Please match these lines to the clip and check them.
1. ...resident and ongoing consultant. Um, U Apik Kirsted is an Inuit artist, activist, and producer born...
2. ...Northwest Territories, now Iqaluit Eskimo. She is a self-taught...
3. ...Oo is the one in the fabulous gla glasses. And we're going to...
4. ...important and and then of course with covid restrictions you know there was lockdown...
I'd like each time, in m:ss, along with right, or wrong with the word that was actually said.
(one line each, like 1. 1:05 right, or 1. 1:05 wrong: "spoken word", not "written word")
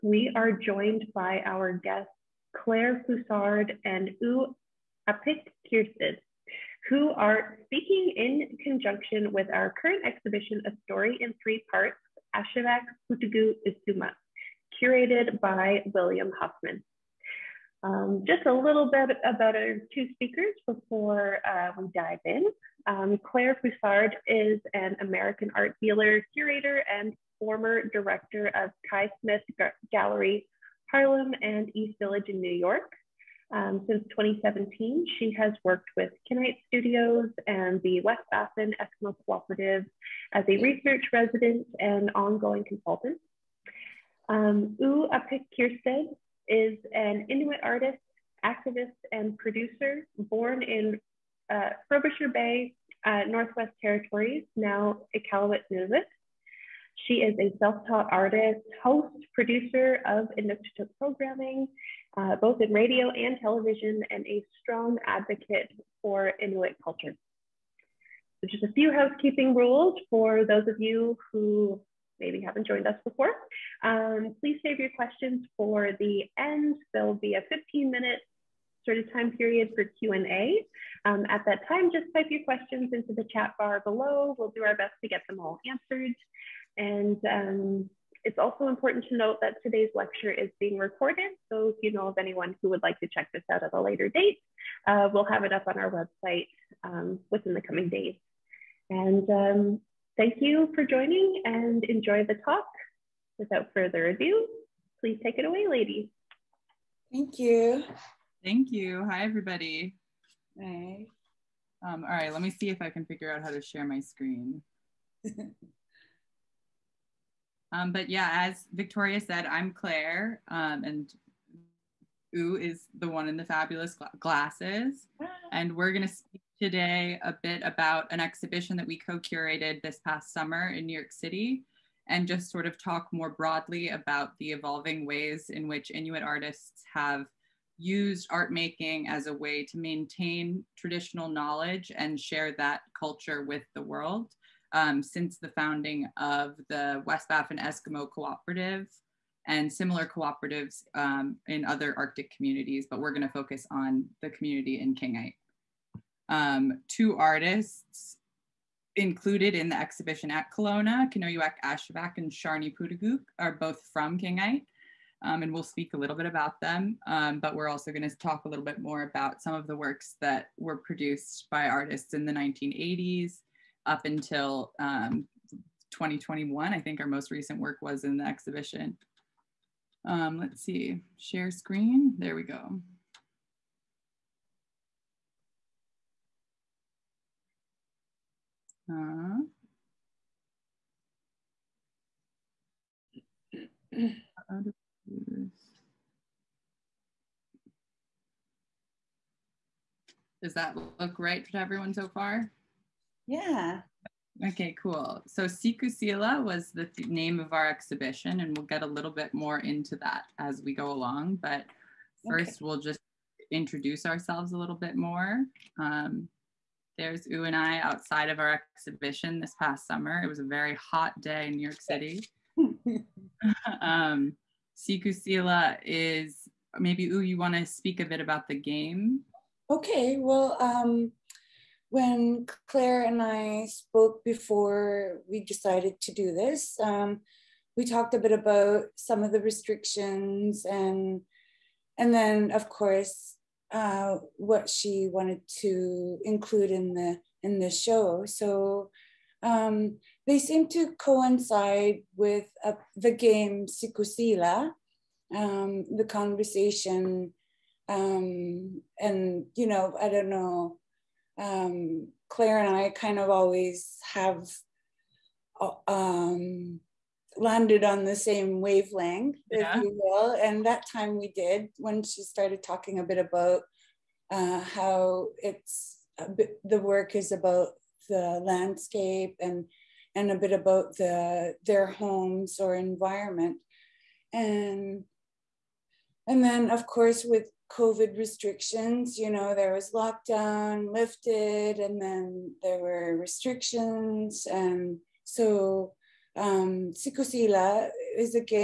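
1. 0:41 right
2. 0:53 wrong: "Nunavut", not "Eskimo"
3. 2:02 right
4. 4:42 wrong: "environment", not "important".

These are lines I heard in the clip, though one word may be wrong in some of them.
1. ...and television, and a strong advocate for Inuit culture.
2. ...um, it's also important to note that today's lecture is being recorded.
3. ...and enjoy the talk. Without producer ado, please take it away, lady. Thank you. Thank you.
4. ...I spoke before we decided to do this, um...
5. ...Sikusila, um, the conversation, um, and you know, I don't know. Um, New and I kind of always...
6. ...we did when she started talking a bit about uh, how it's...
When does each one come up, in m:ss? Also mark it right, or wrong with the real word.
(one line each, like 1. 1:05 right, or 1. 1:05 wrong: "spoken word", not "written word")
1. 1:03 right
2. 1:27 right
3. 1:41 wrong: "further", not "producer"
4. 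3:53 right
5. 4:13 wrong: "Claire", not "New"
6. 4:31 right.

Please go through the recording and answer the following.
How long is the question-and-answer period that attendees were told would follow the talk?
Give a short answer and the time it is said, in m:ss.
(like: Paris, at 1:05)
15 minutes, at 1:17.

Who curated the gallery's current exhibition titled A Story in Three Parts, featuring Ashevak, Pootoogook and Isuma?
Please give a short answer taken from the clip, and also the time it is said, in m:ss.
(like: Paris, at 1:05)
William Huffman, at 0:15.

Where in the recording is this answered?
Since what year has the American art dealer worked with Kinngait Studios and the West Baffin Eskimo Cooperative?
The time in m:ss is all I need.
0:34.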